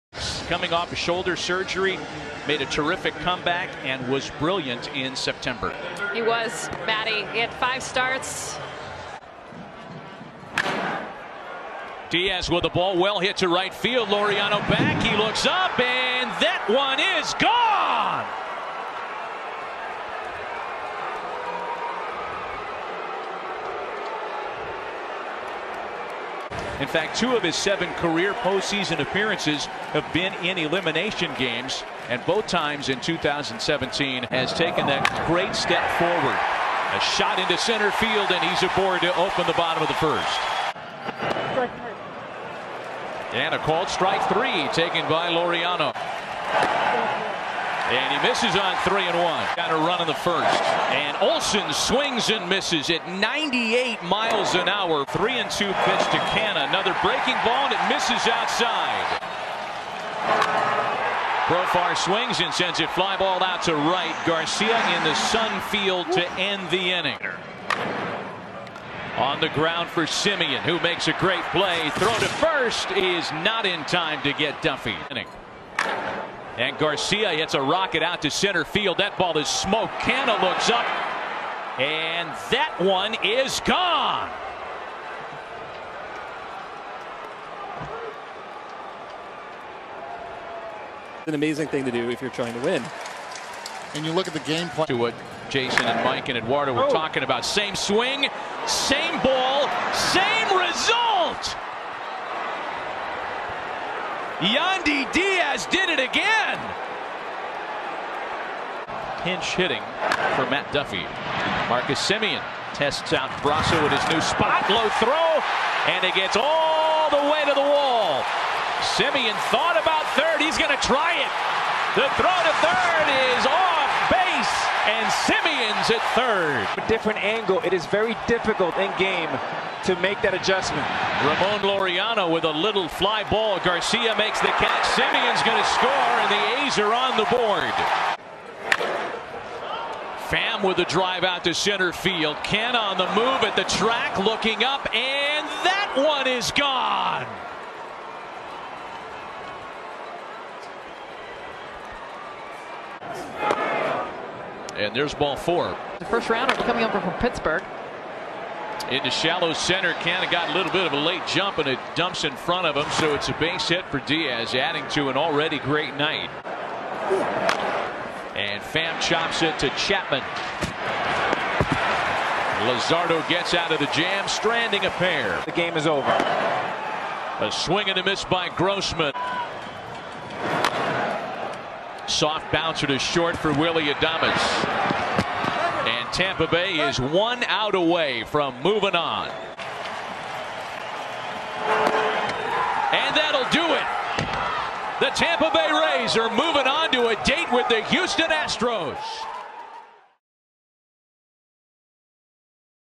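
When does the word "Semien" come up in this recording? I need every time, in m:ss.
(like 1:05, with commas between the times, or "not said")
1:10, 1:52, 1:58, 2:05, 2:14.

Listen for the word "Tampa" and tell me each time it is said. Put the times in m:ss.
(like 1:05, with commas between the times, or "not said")
3:06, 3:15.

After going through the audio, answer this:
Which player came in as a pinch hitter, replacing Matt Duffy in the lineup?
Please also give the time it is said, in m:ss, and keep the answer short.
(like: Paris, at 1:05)
Yandy Diaz, at 1:44.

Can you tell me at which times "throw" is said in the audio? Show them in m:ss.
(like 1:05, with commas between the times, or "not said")
1:11, 1:54, 2:02.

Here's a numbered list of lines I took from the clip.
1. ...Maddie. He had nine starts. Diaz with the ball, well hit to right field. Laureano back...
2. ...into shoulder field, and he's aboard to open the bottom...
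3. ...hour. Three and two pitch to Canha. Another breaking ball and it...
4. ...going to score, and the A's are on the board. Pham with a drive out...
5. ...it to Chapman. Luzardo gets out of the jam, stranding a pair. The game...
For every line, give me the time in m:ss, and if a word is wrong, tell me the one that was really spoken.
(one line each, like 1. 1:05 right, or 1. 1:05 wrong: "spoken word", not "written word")
1. 0:06 wrong: "five", not "nine"
2. 0:37 wrong: "center", not "shoulder"
3. 0:54 right
4. 2:15 right
5. 2:49 right.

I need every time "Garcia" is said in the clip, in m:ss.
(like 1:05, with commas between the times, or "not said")
1:04, 1:16, 2:13.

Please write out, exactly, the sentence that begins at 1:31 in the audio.
An amazing thing to do if you're trying to win.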